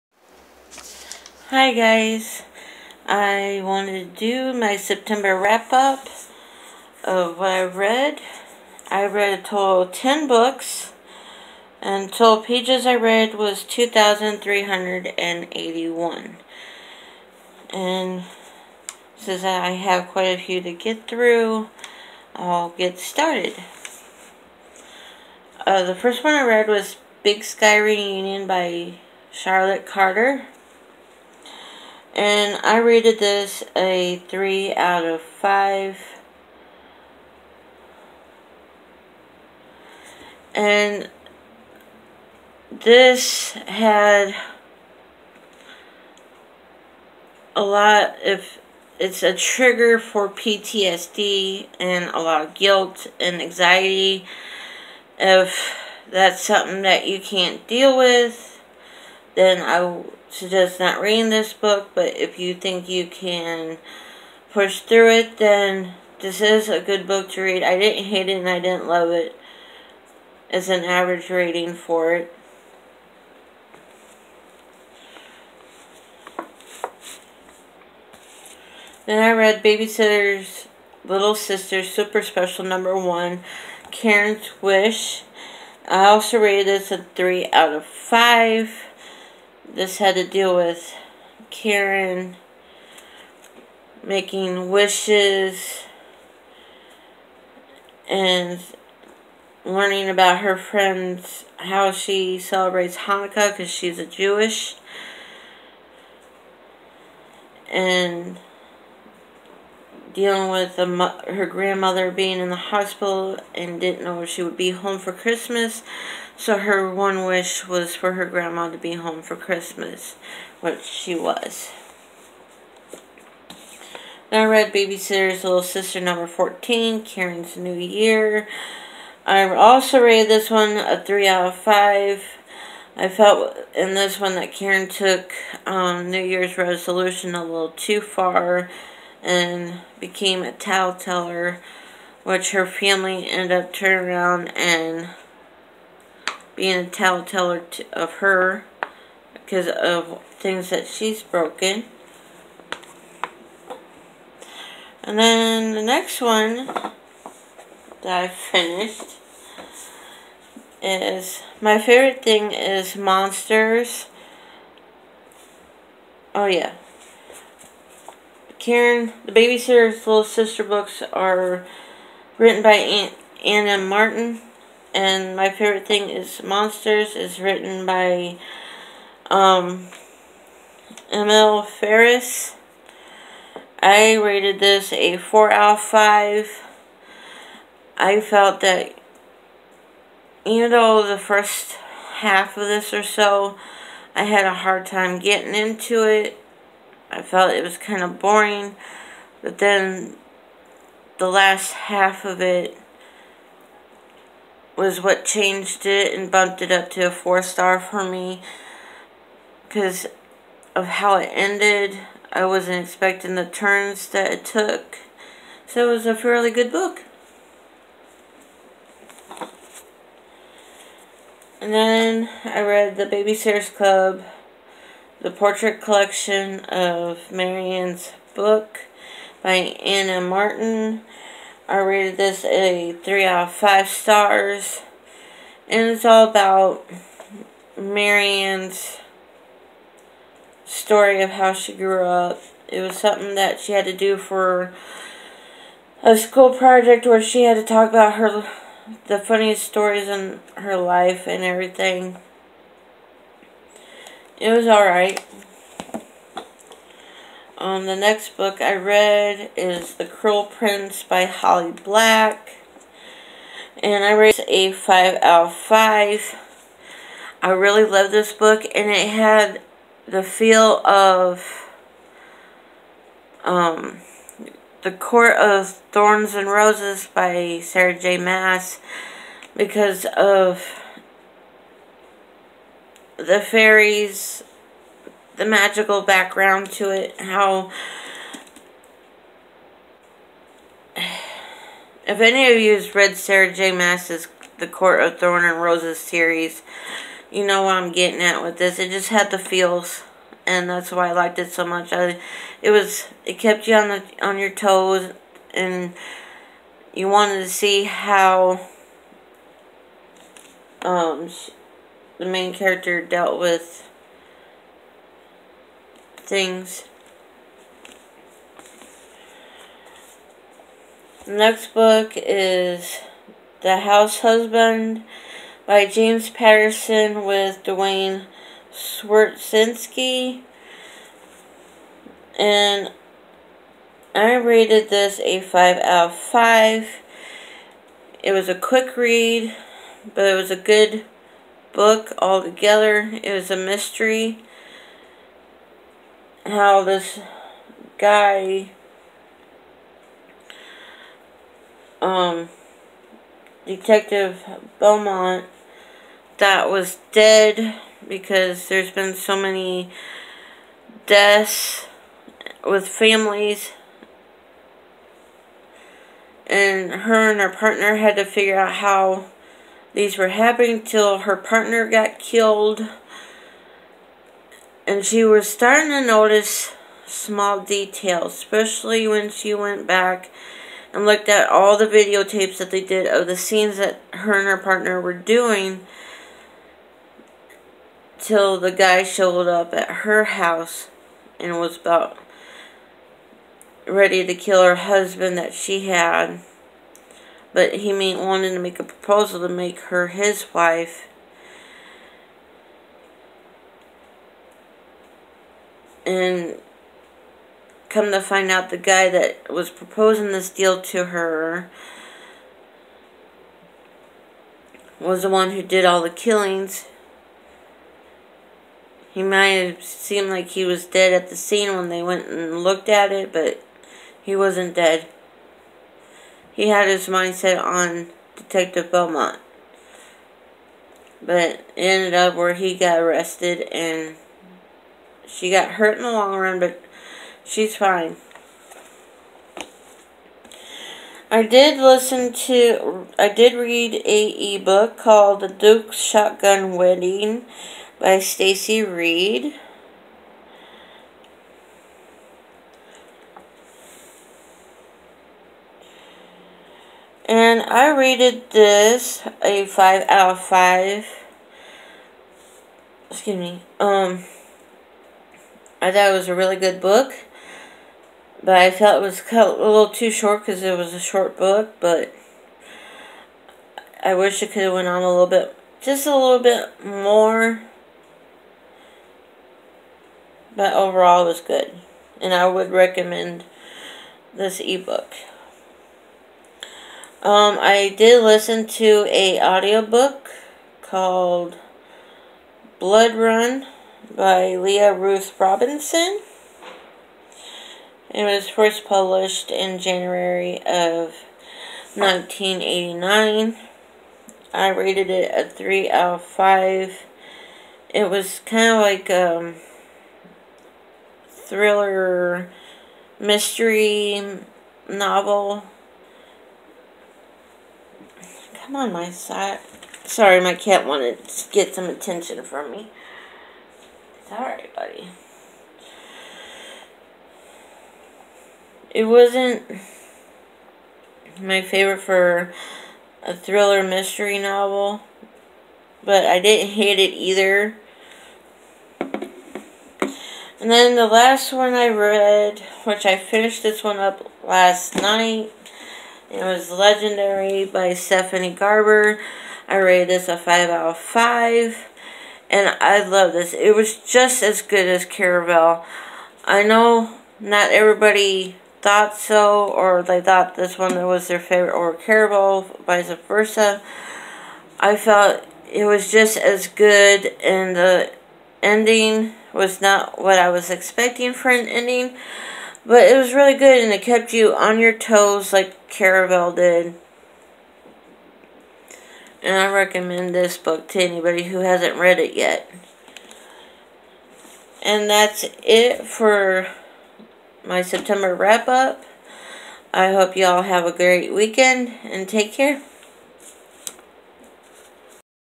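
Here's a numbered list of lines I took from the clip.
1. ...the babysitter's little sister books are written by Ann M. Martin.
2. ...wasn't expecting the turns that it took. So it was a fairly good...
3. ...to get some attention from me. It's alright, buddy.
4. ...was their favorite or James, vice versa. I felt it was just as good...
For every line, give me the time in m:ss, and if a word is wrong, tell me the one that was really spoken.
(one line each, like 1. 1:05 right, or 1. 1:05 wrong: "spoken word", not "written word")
1. 2:49 right
2. 3:32 right
3. 8:41 right
4. 9:21 wrong: "Caraval", not "James".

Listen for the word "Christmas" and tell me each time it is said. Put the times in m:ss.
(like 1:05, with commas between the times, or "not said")
1:55, 1:59.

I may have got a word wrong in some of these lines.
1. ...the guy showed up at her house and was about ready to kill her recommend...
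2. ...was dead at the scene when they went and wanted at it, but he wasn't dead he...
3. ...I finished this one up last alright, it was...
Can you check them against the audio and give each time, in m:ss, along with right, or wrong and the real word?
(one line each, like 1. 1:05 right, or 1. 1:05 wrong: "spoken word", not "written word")
1. 6:28 wrong: "husband", not "recommend"
2. 7:00 wrong: "looked", not "wanted"
3. 9:03 wrong: "night", not "alright".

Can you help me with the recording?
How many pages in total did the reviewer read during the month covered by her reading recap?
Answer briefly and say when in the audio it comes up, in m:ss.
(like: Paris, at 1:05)
2,381, at 0:13.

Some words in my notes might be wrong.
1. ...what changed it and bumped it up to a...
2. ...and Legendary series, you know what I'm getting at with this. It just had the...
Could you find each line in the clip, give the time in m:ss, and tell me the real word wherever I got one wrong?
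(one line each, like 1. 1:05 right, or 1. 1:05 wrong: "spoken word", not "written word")
1. 3:25 right
2. 4:55 wrong: "Roses", not "Legendary".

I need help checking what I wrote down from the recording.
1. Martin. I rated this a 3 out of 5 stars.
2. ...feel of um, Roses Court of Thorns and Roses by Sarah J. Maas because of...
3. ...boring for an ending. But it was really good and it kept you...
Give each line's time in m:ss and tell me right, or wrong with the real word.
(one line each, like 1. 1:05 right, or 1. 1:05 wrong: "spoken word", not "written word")
1. 3:50 right
2. 4:30 wrong: "The", not "Roses"
3. 9:30 wrong: "expecting", not "boring".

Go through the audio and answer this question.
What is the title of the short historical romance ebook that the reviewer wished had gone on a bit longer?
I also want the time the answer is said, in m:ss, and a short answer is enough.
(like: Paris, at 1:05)
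The Duke's Shotgun Wedding, at 7:25.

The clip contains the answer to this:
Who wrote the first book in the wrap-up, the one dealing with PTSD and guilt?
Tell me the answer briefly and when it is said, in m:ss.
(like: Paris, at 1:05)
Charlotte Carter, at 0:29.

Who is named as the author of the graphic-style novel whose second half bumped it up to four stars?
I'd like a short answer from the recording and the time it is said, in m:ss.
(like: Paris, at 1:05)
Emil Ferris, at 3:01.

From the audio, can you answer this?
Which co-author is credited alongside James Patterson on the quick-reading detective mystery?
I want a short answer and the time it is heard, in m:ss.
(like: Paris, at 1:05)
Duane Swierczynski, at 5:27.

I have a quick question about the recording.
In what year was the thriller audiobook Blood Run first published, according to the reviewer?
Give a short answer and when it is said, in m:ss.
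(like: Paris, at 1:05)
1989, at 8:21.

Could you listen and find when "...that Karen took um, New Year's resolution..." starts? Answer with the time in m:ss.
2:14.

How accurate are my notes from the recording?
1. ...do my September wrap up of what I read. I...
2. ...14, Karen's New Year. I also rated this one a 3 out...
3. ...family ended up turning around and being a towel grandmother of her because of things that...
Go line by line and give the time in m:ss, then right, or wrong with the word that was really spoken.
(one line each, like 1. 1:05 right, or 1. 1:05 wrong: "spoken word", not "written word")
1. 0:04 right
2. 2:06 right
3. 2:22 wrong: "teller", not "grandmother".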